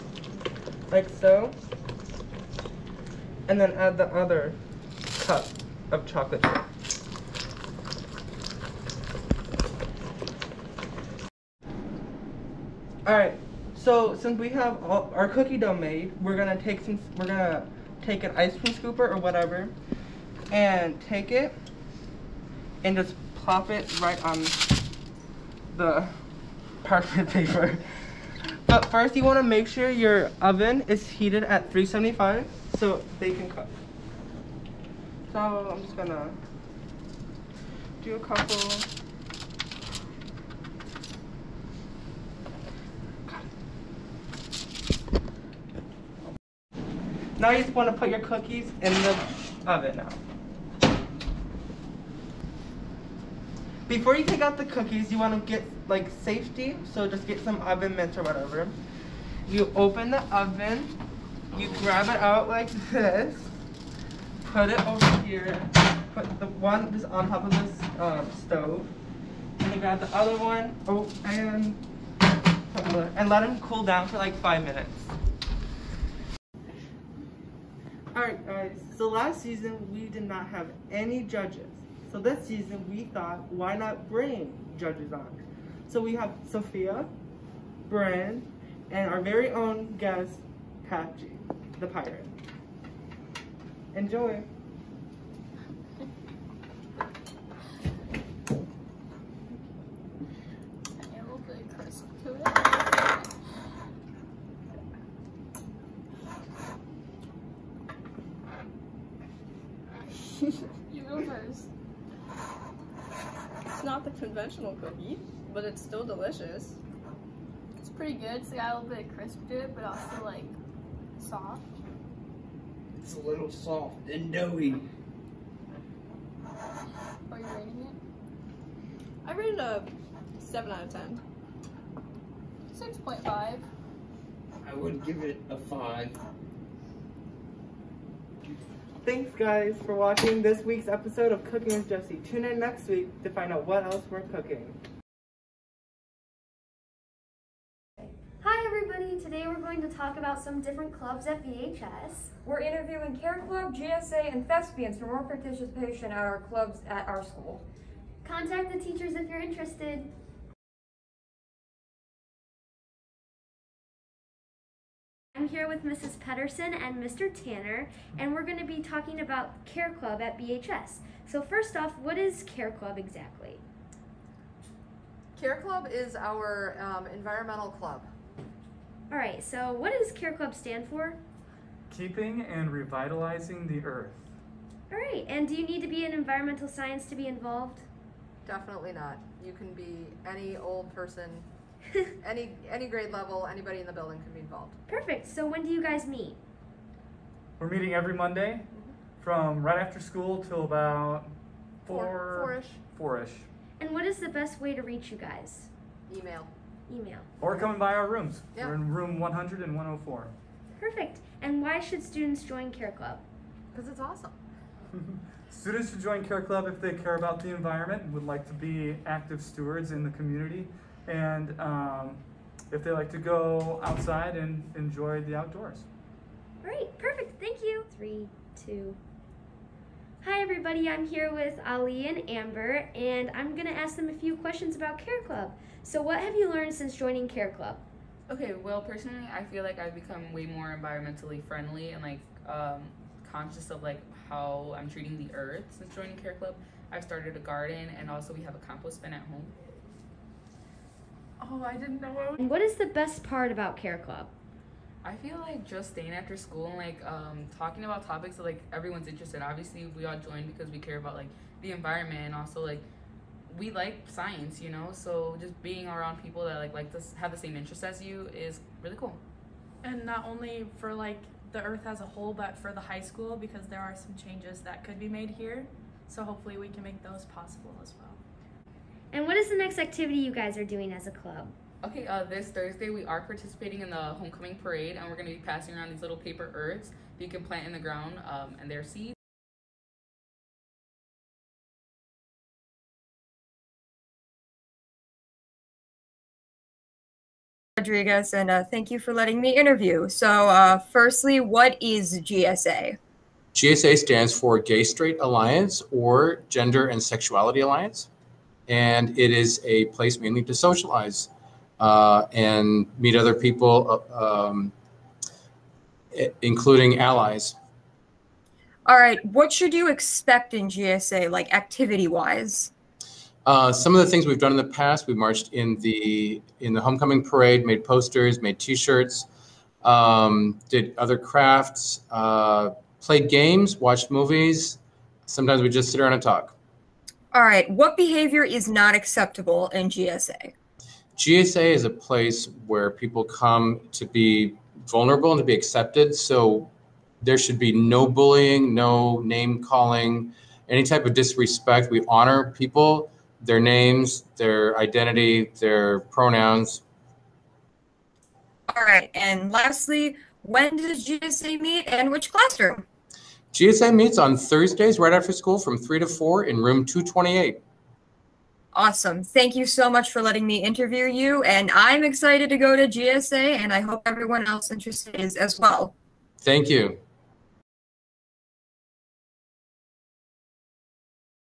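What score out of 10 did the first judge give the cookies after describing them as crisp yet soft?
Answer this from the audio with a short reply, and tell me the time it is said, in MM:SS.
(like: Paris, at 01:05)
7, at 02:10.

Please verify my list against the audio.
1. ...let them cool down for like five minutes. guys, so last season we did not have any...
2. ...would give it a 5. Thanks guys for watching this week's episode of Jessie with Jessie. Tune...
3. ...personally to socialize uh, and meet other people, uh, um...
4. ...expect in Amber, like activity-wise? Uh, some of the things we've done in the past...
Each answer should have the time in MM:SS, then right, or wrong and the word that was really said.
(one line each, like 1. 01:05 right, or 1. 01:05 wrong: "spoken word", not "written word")
1. 01:13 right
2. 02:14 wrong: "Cooking", not "Jessie"
3. 05:10 wrong: "mainly", not "personally"
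4. 05:19 wrong: "GSA", not "Amber".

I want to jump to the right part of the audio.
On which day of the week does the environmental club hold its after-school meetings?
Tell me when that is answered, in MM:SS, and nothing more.
03:18.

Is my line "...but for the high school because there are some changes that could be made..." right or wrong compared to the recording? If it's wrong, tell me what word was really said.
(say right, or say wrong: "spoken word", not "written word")
right.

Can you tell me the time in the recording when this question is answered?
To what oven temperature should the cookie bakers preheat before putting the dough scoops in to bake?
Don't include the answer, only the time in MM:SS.
00:31.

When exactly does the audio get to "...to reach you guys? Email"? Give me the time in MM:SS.
03:24.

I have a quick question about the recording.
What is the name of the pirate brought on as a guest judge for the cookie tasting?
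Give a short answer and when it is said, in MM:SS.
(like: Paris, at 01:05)
Patchy, at 01:30.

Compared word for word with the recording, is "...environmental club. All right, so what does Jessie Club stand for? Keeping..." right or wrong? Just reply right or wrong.
wrong.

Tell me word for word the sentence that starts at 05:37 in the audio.
What behavior is not acceptable in GSA?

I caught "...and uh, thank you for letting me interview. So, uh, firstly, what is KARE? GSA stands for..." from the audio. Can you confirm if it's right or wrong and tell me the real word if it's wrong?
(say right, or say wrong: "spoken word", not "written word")
wrong: "GSA", not "KARE".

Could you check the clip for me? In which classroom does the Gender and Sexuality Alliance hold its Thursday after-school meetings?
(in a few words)
Room 228.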